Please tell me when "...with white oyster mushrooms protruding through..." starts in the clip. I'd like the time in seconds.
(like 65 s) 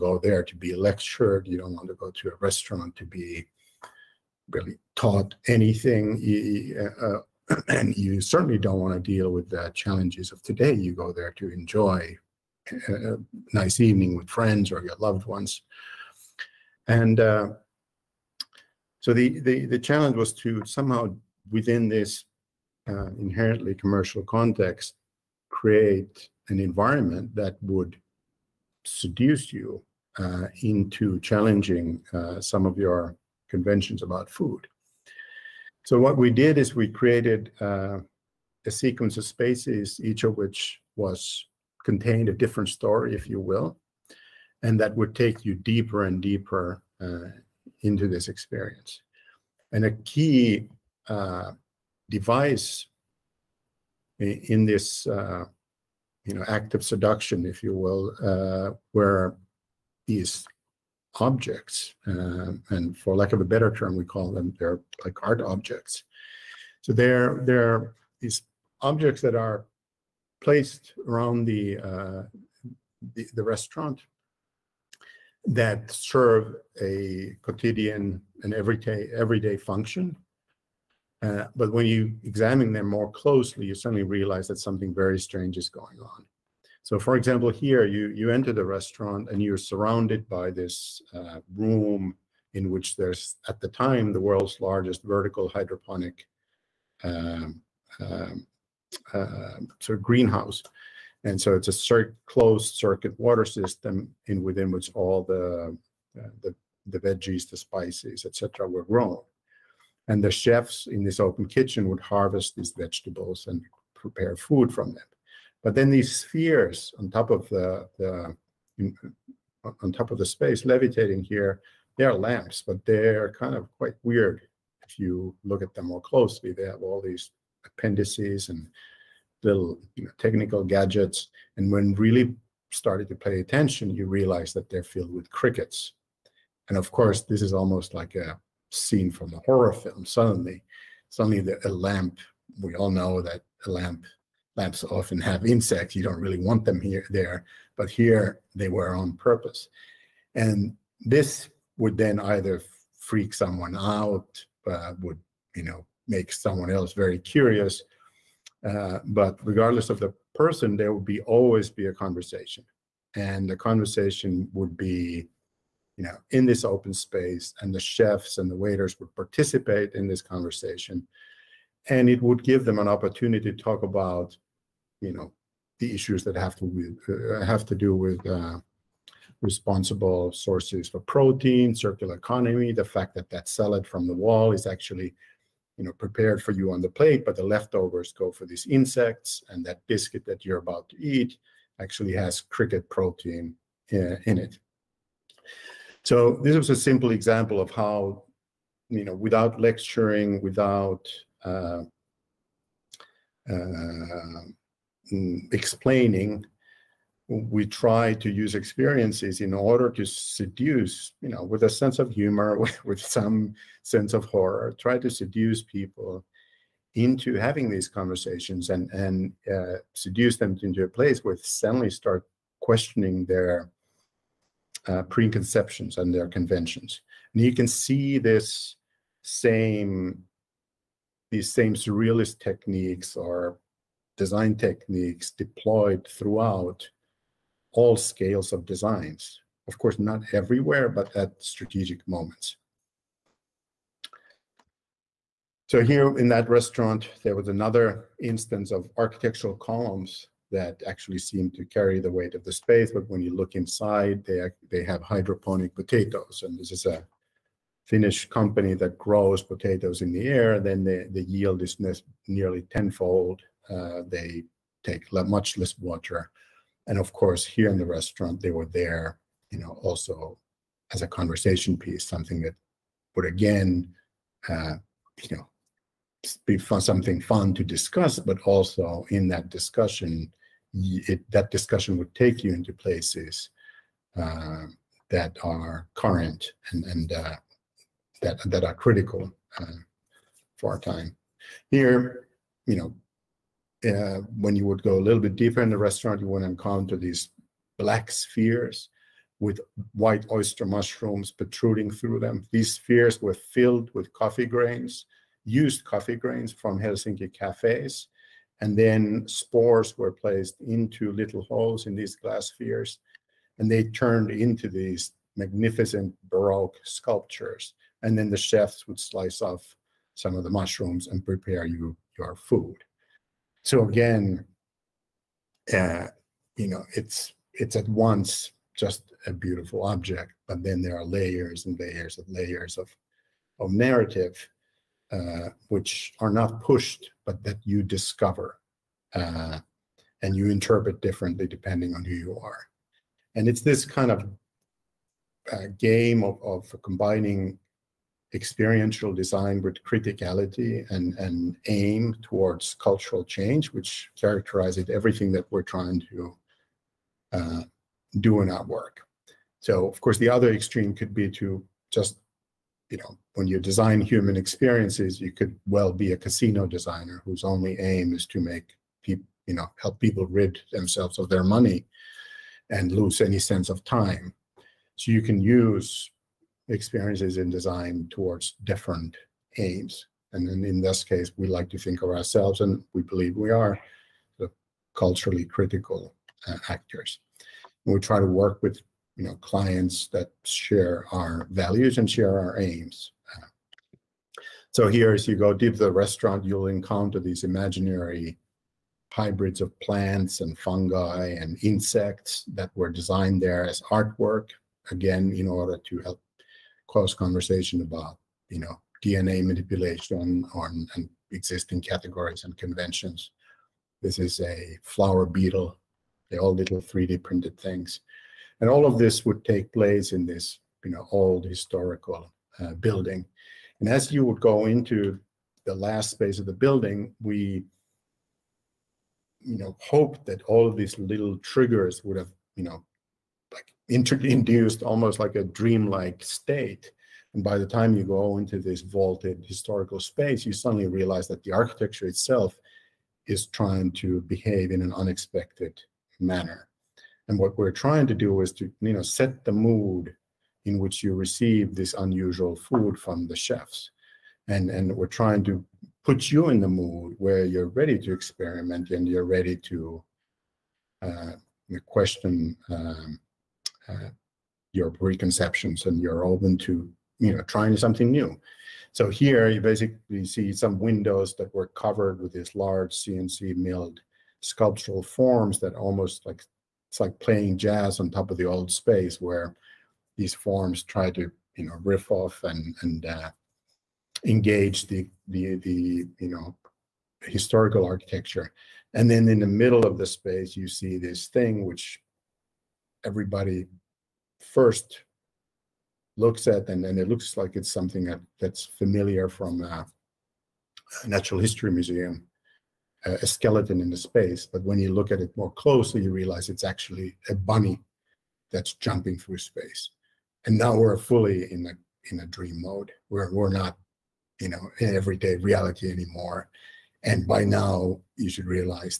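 299 s.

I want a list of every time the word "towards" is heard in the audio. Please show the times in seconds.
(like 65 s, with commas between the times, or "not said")
352 s, 378 s.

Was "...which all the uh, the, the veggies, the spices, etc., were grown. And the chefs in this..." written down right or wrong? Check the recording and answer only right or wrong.
right.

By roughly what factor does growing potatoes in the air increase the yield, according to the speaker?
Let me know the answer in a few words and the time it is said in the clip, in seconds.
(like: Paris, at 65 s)
tenfold, at 262 s.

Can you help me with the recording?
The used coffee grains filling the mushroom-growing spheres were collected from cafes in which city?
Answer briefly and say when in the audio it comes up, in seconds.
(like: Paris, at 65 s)
Helsinki, at 306 s.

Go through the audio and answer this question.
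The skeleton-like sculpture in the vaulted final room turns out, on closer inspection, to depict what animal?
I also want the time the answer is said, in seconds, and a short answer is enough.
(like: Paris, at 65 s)
bunny, at 507 s.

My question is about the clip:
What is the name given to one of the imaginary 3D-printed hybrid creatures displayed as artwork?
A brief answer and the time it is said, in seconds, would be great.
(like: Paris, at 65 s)
flower beetle, at 414 s.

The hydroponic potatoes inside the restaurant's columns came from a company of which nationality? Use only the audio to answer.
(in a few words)
Finnish.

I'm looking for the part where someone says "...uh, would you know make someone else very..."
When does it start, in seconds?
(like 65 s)
154 s.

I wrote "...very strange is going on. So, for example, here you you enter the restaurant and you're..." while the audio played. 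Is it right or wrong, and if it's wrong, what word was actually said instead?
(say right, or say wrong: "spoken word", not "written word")
right.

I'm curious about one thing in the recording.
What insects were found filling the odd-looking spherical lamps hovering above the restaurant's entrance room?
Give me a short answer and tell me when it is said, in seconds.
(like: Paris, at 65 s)
crickets, at 135 s.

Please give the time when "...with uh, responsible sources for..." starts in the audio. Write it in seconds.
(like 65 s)
177 s.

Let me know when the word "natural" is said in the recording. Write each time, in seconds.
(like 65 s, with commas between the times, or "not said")
501 s.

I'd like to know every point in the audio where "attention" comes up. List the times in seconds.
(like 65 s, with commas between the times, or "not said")
133 s.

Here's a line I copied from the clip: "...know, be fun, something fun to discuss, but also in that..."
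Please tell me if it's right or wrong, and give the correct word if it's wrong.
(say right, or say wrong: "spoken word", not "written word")
right.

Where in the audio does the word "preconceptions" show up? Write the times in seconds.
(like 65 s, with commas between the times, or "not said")
225 s, 464 s.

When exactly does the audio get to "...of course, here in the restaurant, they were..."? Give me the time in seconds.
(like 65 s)
266 s.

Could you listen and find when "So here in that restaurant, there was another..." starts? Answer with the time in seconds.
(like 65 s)
245 s.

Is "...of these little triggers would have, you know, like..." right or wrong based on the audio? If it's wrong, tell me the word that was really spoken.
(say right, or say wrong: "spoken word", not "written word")
right.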